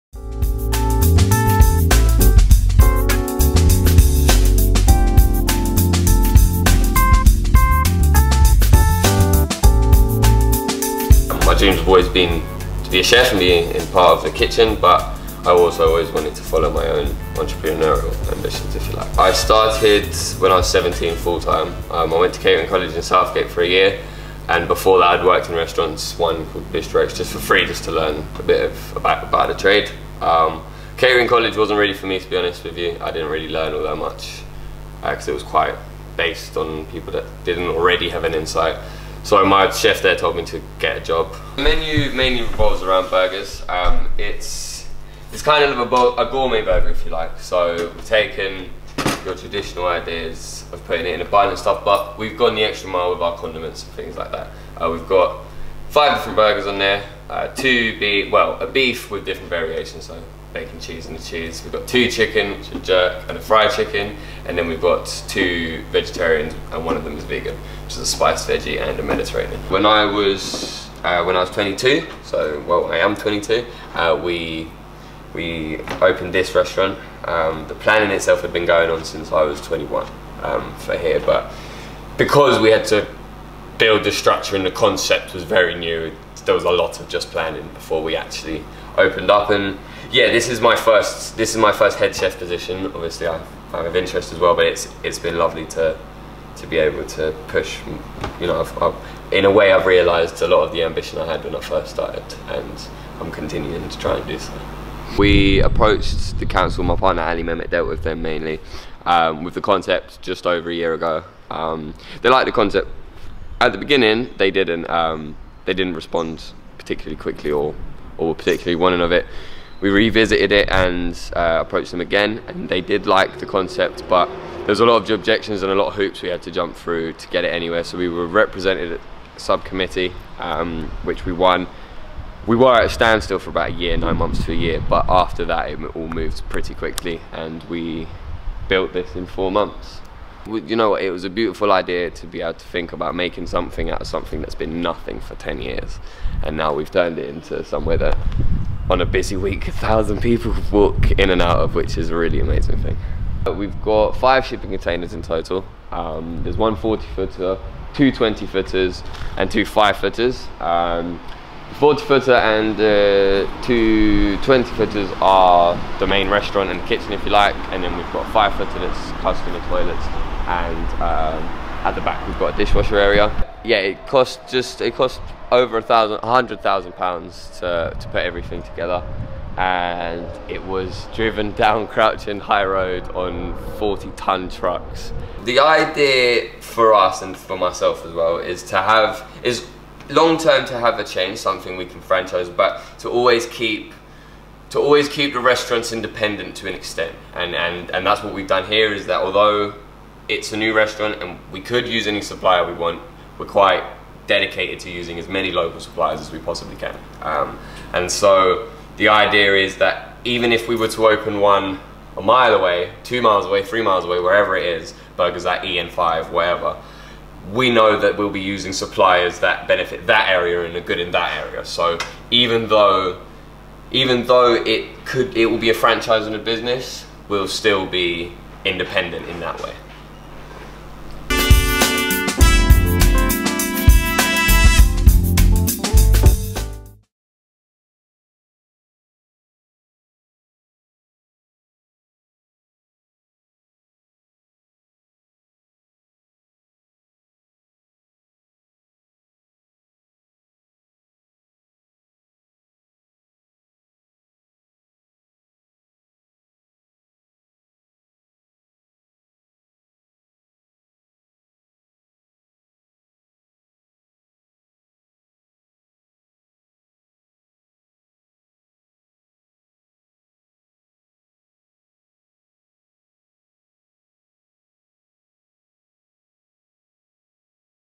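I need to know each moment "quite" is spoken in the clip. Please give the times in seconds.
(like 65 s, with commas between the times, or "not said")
35 s, 203 s.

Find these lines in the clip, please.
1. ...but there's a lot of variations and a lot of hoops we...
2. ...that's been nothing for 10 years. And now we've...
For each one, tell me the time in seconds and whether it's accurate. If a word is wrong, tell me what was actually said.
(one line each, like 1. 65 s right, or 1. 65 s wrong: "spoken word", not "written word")
1. 124 s wrong: "objections", not "variations"
2. 144 s right.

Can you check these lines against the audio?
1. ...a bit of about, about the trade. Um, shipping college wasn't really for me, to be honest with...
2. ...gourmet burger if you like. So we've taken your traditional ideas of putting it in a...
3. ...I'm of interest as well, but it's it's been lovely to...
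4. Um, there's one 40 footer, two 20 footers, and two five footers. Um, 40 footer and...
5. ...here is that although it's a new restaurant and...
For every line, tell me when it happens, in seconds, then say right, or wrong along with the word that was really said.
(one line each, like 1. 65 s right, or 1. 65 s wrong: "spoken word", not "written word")
1. 28 s wrong: "catering", not "shipping"
2. 46 s right
3. 93 s right
4. 155 s right
5. 198 s right.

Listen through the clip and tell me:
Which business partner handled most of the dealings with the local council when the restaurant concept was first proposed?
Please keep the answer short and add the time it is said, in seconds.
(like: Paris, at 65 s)
Ali Mehmet, at 107 s.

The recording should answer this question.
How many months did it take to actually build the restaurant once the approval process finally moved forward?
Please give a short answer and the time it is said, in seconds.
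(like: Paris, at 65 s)
4 months, at 139 s.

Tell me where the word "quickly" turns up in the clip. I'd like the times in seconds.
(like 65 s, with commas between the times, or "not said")
117 s, 136 s.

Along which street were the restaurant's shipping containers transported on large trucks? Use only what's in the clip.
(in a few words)
Crouch End High Road.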